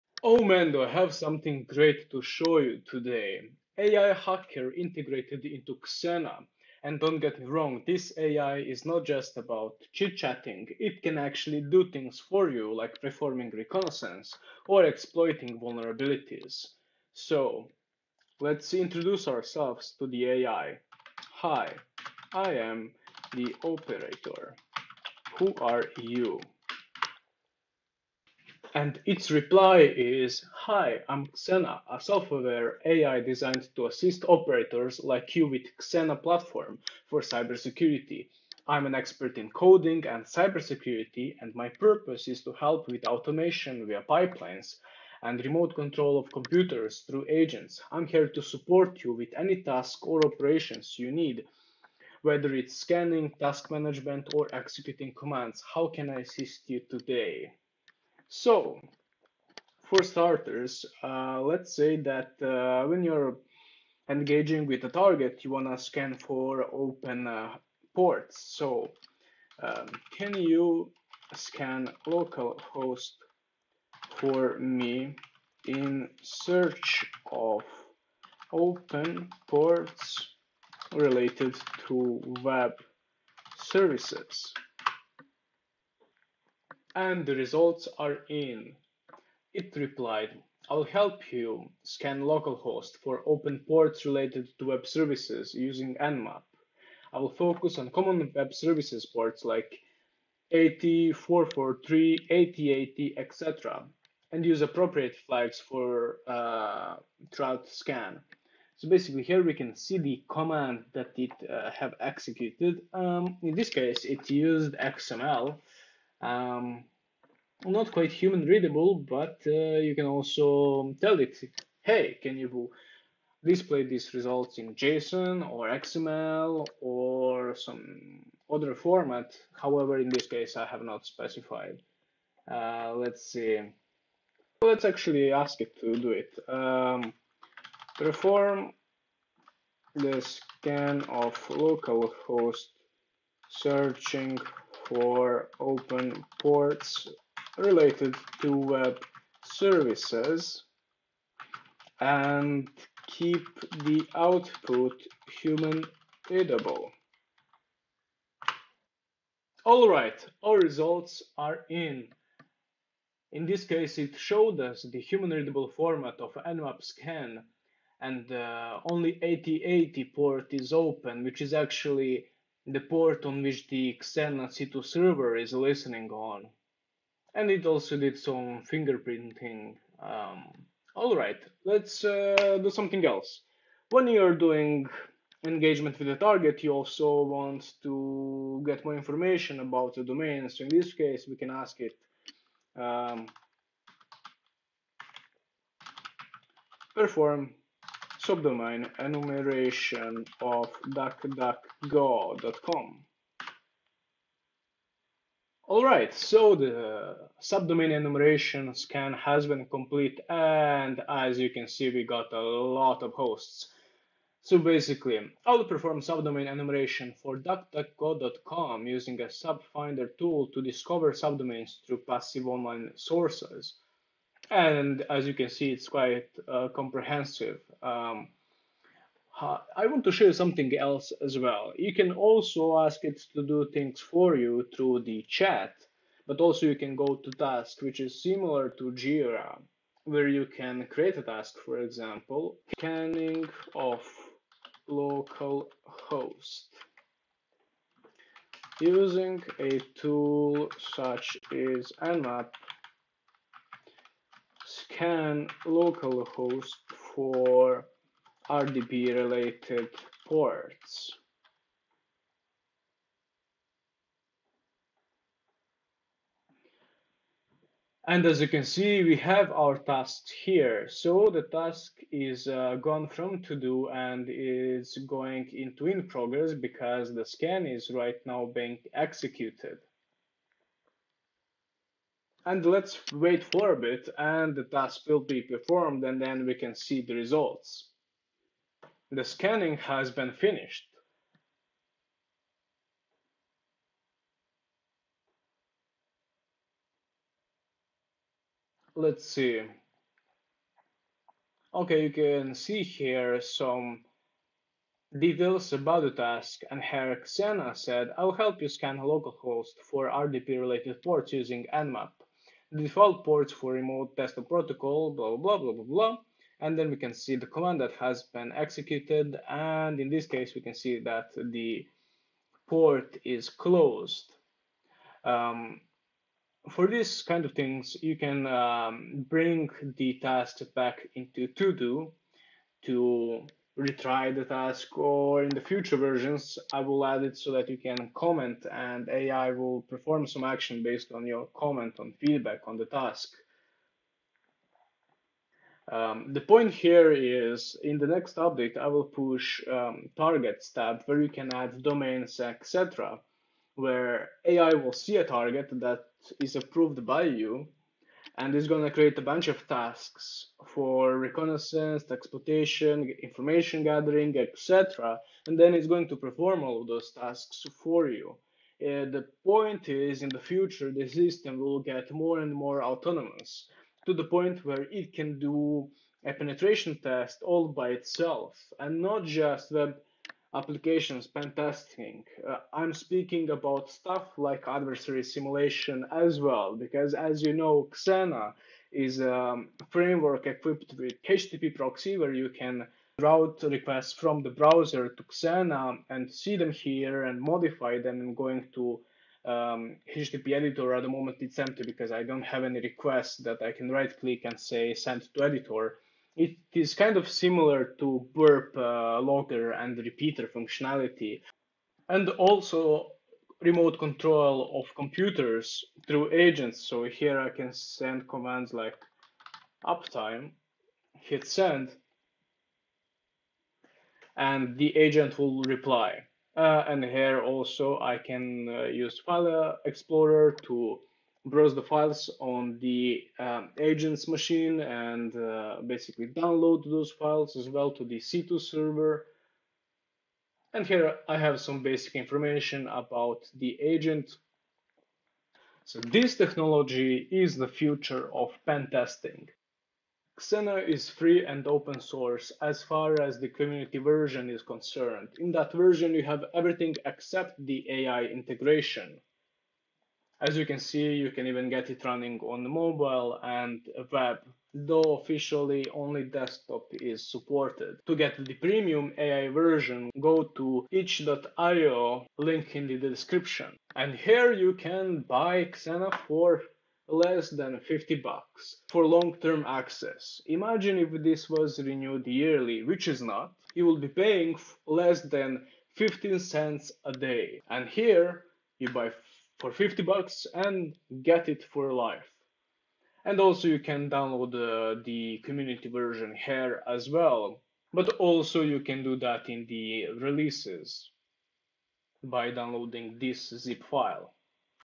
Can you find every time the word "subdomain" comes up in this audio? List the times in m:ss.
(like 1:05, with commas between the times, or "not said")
3:18, 3:27, 3:36, 3:41.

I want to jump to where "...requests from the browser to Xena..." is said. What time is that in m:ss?
6:33.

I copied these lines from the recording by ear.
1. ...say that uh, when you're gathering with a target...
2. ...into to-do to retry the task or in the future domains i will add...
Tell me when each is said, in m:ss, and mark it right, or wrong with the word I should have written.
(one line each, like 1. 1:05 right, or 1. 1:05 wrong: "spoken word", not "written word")
1. 1:01 wrong: "engaging", not "gathering"
2. 5:31 wrong: "versions", not "domains".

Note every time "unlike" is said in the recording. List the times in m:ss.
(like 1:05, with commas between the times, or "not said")
not said.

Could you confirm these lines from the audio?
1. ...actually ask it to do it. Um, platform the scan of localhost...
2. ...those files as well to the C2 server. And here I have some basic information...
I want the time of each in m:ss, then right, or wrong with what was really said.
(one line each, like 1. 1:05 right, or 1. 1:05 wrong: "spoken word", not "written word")
1. 2:14 wrong: "perform", not "platform"
2. 7:16 right.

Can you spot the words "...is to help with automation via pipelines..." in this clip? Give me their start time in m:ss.
0:42.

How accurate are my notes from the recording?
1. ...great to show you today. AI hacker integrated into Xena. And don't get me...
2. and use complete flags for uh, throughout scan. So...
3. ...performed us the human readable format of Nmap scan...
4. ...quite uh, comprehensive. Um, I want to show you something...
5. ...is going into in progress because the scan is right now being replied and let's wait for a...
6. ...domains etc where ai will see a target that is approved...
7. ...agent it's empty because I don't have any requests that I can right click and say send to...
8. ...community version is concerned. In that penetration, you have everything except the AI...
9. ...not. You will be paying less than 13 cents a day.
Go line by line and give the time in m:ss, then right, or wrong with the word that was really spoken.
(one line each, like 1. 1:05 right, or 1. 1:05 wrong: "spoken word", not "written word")
1. 0:01 right
2. 1:44 wrong: "appropriate", not "complete"
3. 2:44 wrong: "showed", not "performed"
4. 3:45 right
5. 4:34 wrong: "executed", not "replied"
6. 5:51 right
7. 6:41 wrong: "moment", not "agent"
8. 7:33 wrong: "version", not "penetration"
9. 8:03 wrong: "15", not "13".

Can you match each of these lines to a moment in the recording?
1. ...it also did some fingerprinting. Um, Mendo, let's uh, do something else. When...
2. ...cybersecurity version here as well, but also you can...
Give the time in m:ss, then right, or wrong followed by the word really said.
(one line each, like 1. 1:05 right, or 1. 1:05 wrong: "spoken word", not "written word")
1. 2:57 wrong: "Alright", not "Mendo"
2. 8:15 wrong: "community", not "cybersecurity".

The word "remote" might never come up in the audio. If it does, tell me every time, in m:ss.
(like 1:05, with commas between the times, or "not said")
0:45, 5:13, 6:53.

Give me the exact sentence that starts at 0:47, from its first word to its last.
I'm here to support you with any task or operations you need, whether it's scanning, task management, or executing commands.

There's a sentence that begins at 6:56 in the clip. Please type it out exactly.
So here I can send commands like uptime, hit send, and the agent will reply.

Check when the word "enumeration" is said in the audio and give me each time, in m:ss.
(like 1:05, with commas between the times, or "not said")
3:18, 3:27, 3:36.